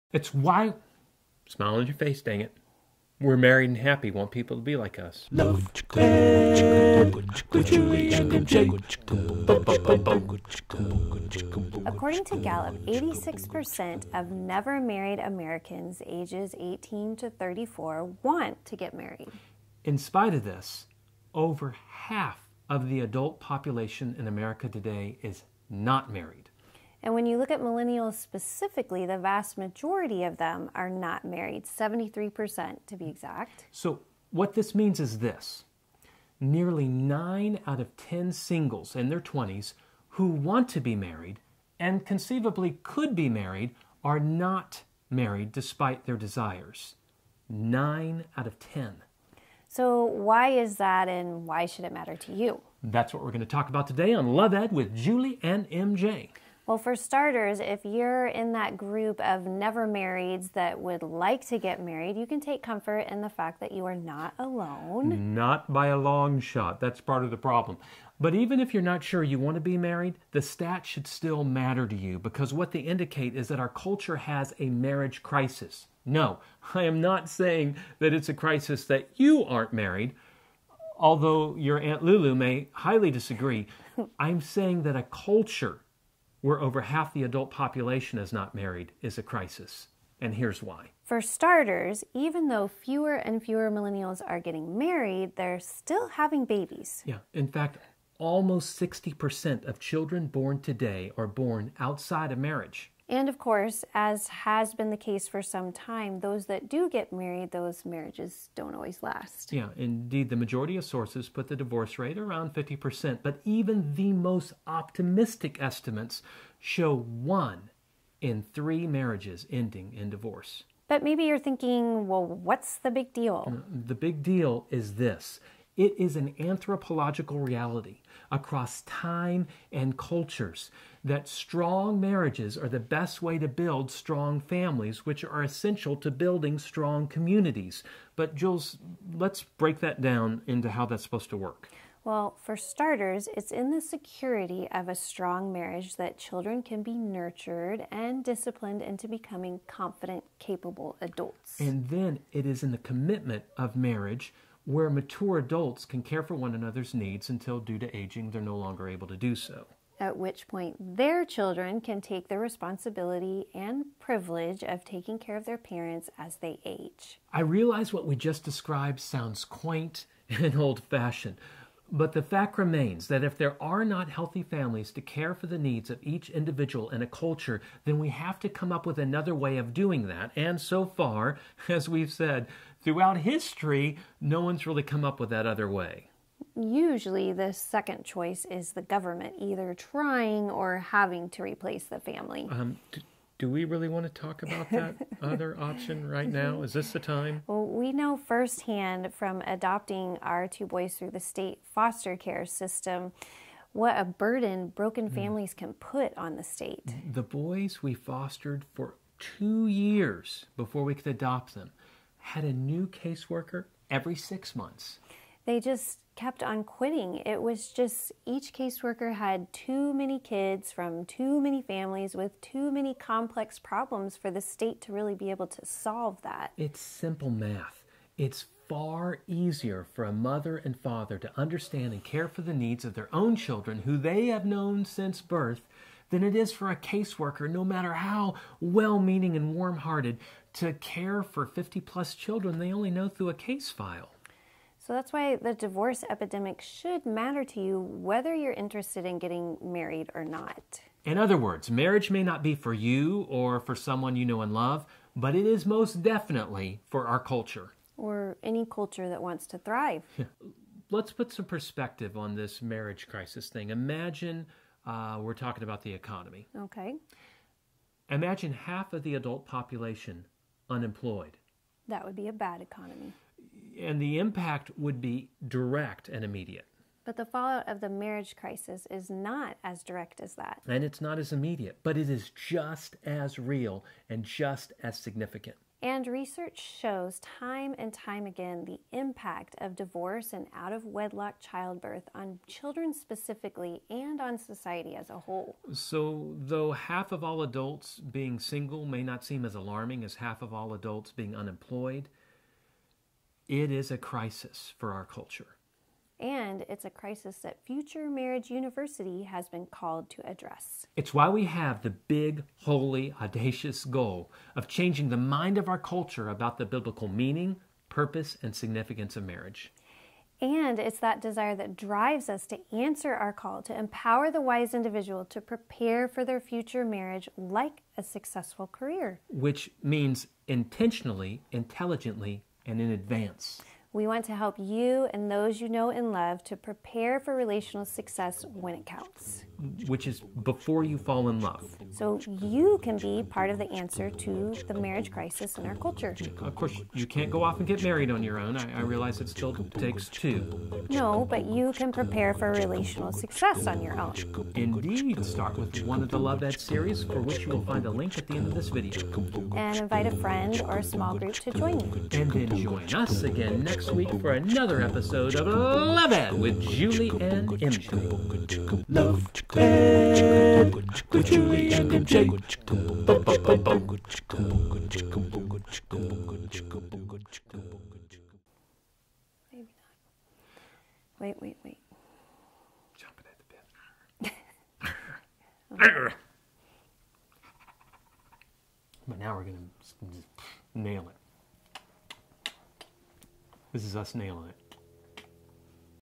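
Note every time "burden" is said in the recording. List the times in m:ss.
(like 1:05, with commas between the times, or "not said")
3:24.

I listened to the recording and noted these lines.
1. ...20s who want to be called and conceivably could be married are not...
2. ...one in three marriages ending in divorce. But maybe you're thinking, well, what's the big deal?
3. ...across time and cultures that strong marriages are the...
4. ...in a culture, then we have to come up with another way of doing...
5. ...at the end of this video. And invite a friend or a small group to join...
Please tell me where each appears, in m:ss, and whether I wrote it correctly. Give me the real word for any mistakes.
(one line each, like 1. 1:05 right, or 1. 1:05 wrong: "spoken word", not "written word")
1. 0:39 wrong: "married", not "called"
2. 1:56 right
3. 2:08 right
4. 2:56 right
5. 5:58 right.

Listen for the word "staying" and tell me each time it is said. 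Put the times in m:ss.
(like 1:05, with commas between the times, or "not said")
not said.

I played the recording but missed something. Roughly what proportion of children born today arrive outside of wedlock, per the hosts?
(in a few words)
almost 60%.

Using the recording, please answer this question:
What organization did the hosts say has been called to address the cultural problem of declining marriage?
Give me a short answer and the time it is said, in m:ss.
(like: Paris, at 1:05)
Future Marriage University, at 5:07.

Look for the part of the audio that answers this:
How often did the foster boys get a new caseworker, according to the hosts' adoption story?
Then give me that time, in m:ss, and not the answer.
3:33.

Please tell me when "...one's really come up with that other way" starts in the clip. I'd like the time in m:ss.
3:04.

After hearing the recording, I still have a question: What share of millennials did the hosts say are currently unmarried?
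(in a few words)
73%.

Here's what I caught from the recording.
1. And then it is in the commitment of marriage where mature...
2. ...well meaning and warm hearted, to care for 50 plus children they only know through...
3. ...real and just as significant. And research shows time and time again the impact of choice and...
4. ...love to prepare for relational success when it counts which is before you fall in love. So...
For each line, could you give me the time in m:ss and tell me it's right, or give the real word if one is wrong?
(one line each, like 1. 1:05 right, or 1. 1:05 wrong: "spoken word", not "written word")
1. 2:31 right
2. 3:58 right
3. 4:43 wrong: "divorce", not "choice"
4. 5:36 right.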